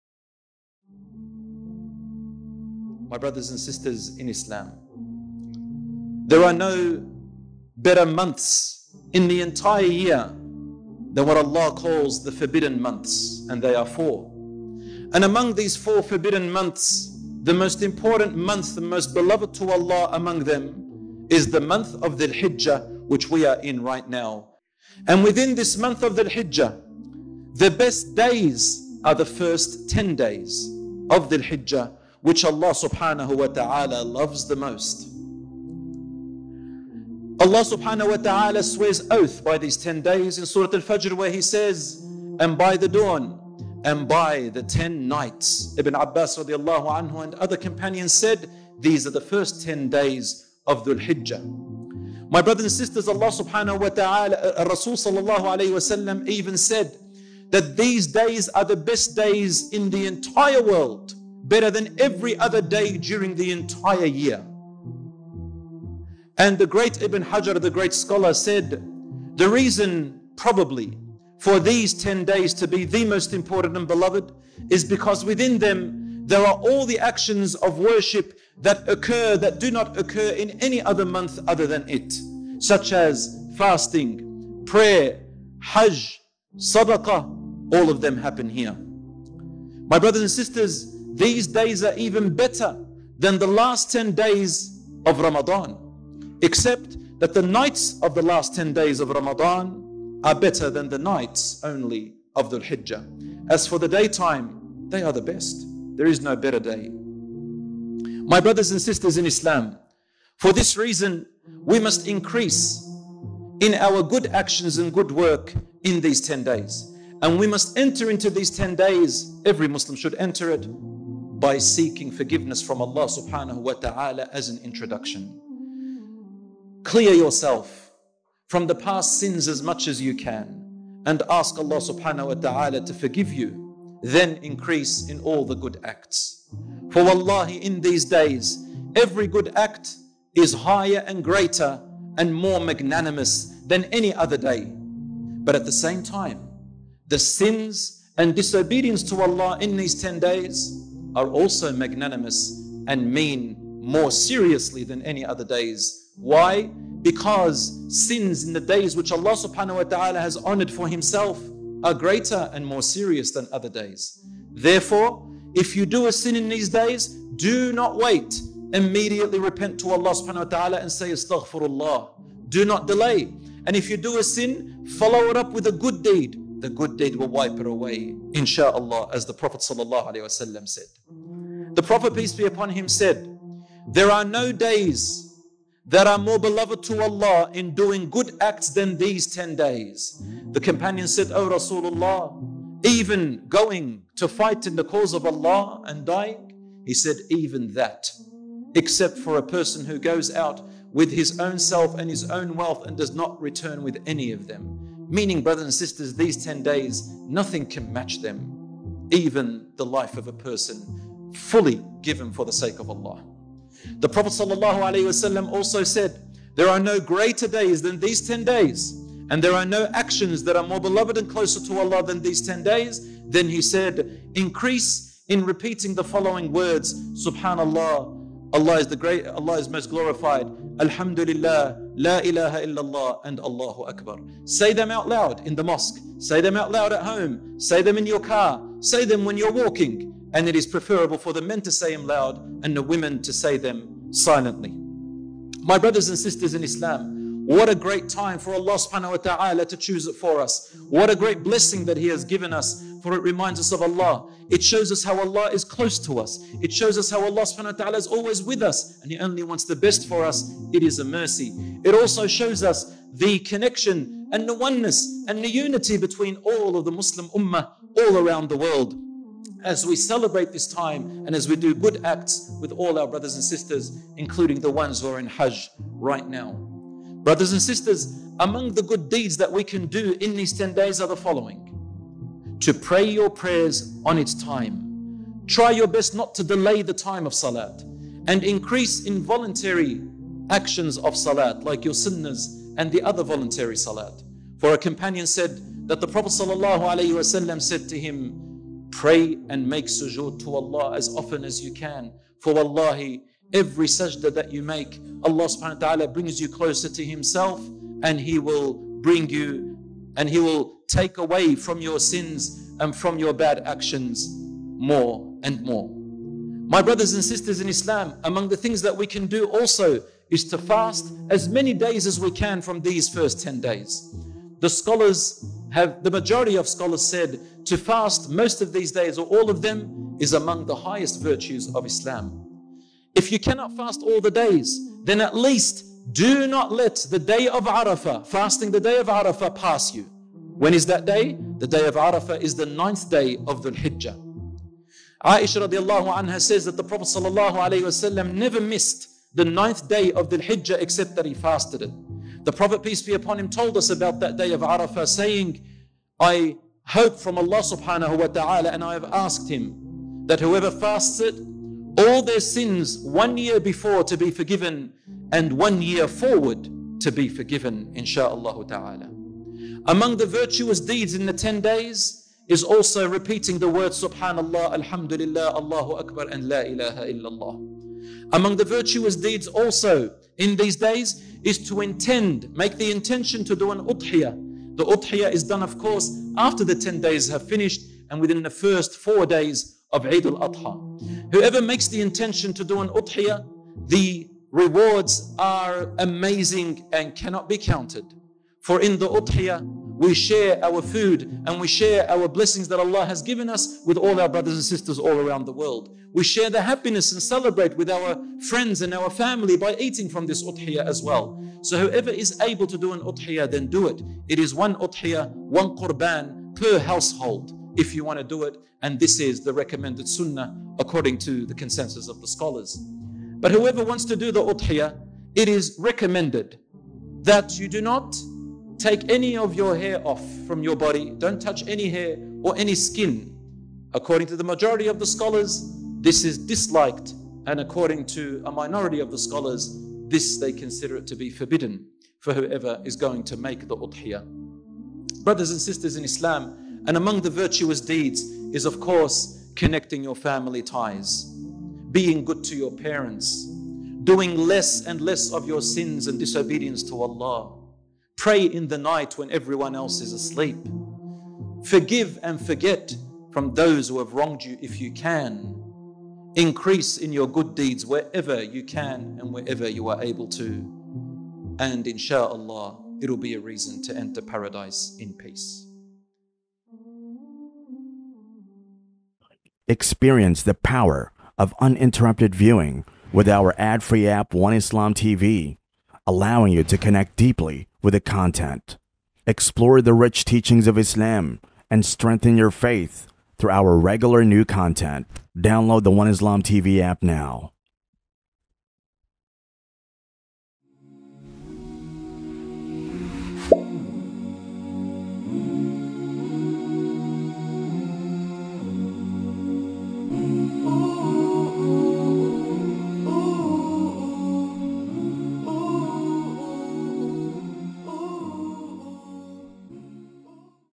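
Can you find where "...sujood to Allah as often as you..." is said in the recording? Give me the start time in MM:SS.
04:59.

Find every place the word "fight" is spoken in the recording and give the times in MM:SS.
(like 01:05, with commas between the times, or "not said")
03:14.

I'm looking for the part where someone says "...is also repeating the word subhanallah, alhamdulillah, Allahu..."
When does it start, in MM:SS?
06:12.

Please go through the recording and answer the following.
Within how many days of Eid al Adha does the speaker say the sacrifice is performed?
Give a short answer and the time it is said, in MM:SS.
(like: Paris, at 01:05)
first 4 days, at 06:28.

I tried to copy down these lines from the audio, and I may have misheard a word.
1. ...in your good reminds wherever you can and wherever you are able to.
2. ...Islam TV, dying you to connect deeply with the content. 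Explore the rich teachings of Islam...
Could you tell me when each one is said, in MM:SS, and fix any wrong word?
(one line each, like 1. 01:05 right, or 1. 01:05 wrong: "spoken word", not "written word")
1. 07:46 wrong: "deeds", not "reminds"
2. 08:04 wrong: "allowing", not "dying".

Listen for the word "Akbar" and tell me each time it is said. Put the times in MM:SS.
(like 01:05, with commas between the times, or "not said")
03:53, 06:15.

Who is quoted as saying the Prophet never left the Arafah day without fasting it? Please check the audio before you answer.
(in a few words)
Aisha.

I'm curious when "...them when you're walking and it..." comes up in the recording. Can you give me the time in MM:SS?
03:59.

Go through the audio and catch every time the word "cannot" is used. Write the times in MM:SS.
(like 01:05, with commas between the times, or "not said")
05:33, 06:37.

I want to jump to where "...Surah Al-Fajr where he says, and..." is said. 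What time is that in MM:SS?
00:40.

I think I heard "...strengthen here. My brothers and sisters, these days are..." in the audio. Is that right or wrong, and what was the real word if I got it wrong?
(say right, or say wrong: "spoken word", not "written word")
wrong: "happen", not "strengthen".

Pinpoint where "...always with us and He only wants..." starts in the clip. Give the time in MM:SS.
04:18.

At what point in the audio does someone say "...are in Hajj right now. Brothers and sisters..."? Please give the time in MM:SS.
04:35.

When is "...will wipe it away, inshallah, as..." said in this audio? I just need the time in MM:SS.
02:57.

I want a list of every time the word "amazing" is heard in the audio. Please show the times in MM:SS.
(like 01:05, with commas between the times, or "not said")
06:35.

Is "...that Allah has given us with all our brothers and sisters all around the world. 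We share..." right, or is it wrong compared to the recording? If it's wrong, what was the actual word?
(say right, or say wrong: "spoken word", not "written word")
right.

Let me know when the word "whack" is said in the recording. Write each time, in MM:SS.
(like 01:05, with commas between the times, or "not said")
not said.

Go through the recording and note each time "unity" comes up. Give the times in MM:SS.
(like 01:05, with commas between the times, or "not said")
04:25.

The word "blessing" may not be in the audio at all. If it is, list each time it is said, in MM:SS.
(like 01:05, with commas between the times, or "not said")
04:11, 06:42.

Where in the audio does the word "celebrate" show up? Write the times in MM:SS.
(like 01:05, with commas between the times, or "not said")
04:29, 06:47.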